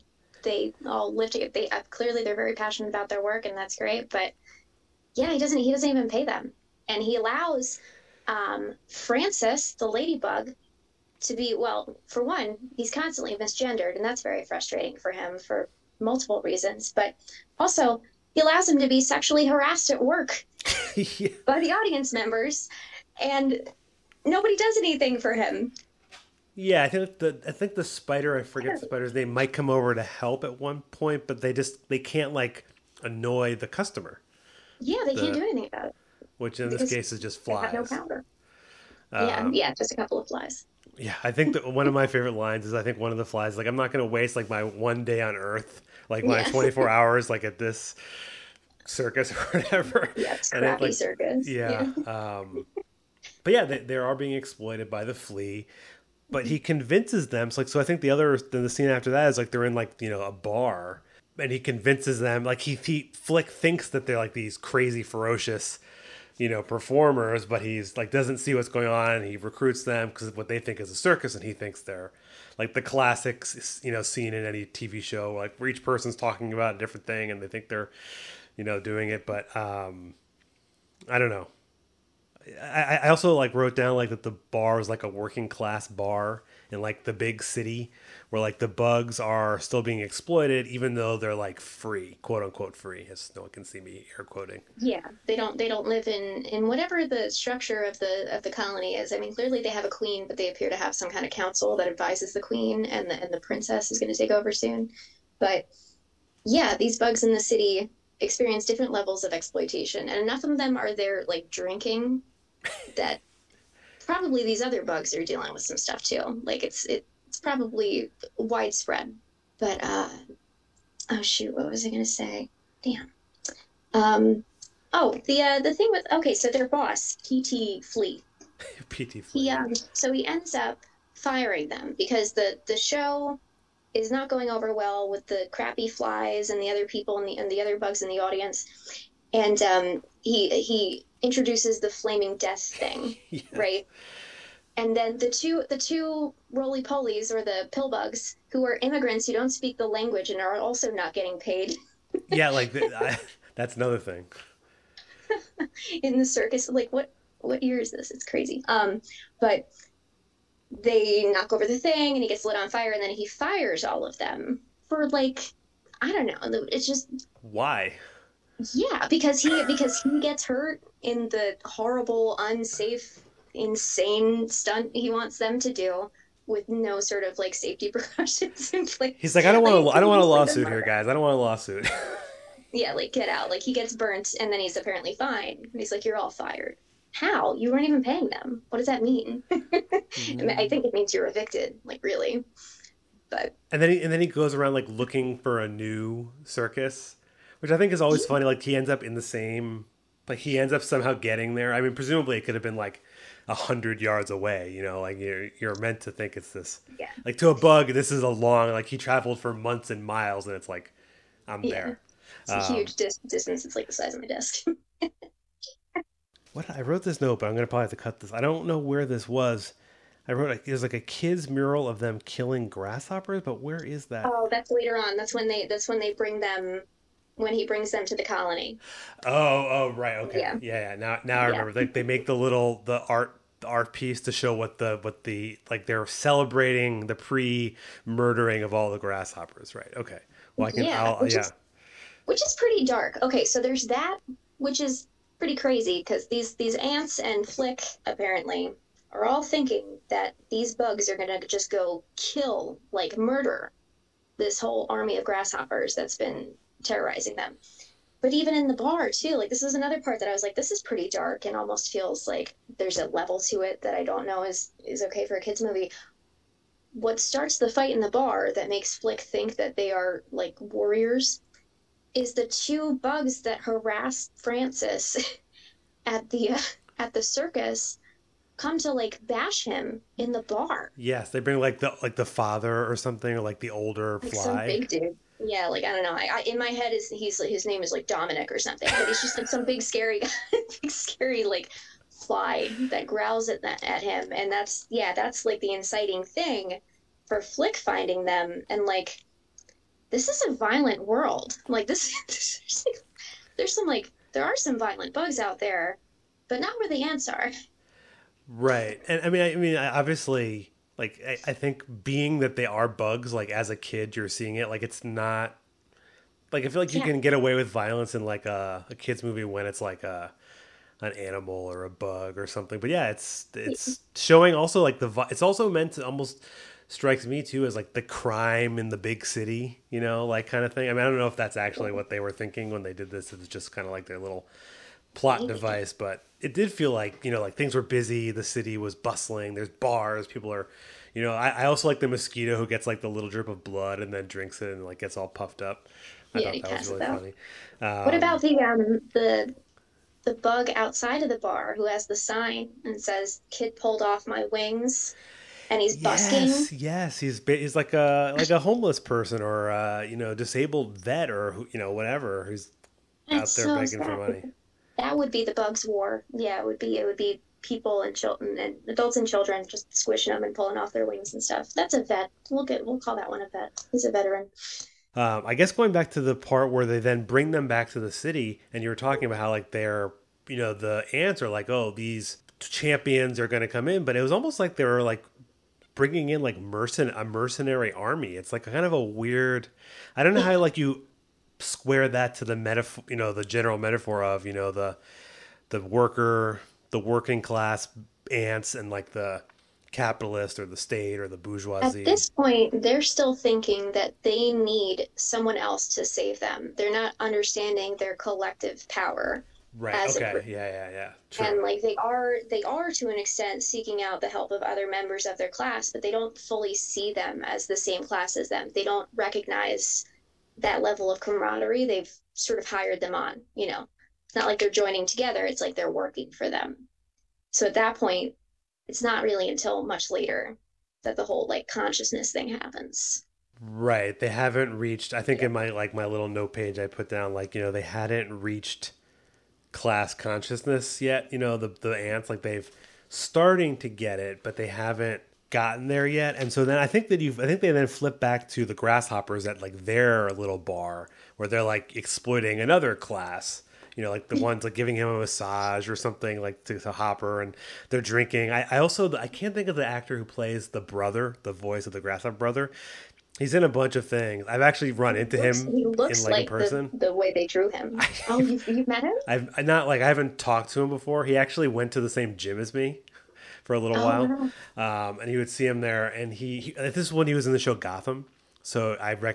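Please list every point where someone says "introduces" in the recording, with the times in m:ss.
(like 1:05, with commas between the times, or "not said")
2:21.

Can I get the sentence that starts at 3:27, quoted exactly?
like to a bug this is a long like he traveled for months and miles and it's like i'm yeah.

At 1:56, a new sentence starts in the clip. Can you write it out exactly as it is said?
Like it's it, it's probably widespread.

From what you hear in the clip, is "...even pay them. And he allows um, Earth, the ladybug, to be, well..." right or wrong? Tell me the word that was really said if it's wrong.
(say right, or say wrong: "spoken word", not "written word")
wrong: "Francis", not "Earth".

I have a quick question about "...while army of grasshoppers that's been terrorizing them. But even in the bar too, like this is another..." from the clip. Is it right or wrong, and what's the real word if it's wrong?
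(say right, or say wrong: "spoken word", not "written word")
wrong: "whole", not "while".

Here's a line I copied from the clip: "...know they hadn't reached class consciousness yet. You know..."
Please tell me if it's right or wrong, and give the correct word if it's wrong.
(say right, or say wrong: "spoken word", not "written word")
right.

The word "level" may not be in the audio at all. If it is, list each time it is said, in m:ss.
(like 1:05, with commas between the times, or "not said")
1:48, 4:23, 7:00.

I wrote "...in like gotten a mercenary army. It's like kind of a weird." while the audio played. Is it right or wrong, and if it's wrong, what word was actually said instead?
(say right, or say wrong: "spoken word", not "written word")
wrong: "mercen", not "gotten".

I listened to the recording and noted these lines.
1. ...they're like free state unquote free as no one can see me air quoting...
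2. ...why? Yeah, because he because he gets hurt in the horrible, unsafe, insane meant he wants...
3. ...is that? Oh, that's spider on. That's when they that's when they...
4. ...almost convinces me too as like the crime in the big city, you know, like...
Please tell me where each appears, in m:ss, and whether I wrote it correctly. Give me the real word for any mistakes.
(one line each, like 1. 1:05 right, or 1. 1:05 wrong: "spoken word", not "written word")
1. 1:31 wrong: "quote", not "state"
2. 2:47 wrong: "stunt", not "meant"
3. 3:43 wrong: "later", not "spider"
4. 5:26 wrong: "strikes", not "convinces".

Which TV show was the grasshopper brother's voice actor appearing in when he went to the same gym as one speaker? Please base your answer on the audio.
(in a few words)
Gotham.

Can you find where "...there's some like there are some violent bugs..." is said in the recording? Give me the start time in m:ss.
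5:03.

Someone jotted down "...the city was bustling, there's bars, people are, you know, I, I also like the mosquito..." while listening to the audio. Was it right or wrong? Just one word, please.
right.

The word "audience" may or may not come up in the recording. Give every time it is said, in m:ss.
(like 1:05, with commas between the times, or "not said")
0:21, 2:18.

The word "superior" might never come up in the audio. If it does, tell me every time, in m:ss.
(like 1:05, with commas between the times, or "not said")
not said.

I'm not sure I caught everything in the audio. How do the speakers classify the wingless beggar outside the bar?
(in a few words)
a veteran.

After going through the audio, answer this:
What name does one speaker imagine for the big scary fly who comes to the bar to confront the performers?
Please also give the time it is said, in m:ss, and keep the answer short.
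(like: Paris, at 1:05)
Dominic, at 4:48.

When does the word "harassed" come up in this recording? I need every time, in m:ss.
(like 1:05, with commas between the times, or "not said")
0:19, 4:33.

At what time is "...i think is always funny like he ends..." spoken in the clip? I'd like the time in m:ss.
3:17.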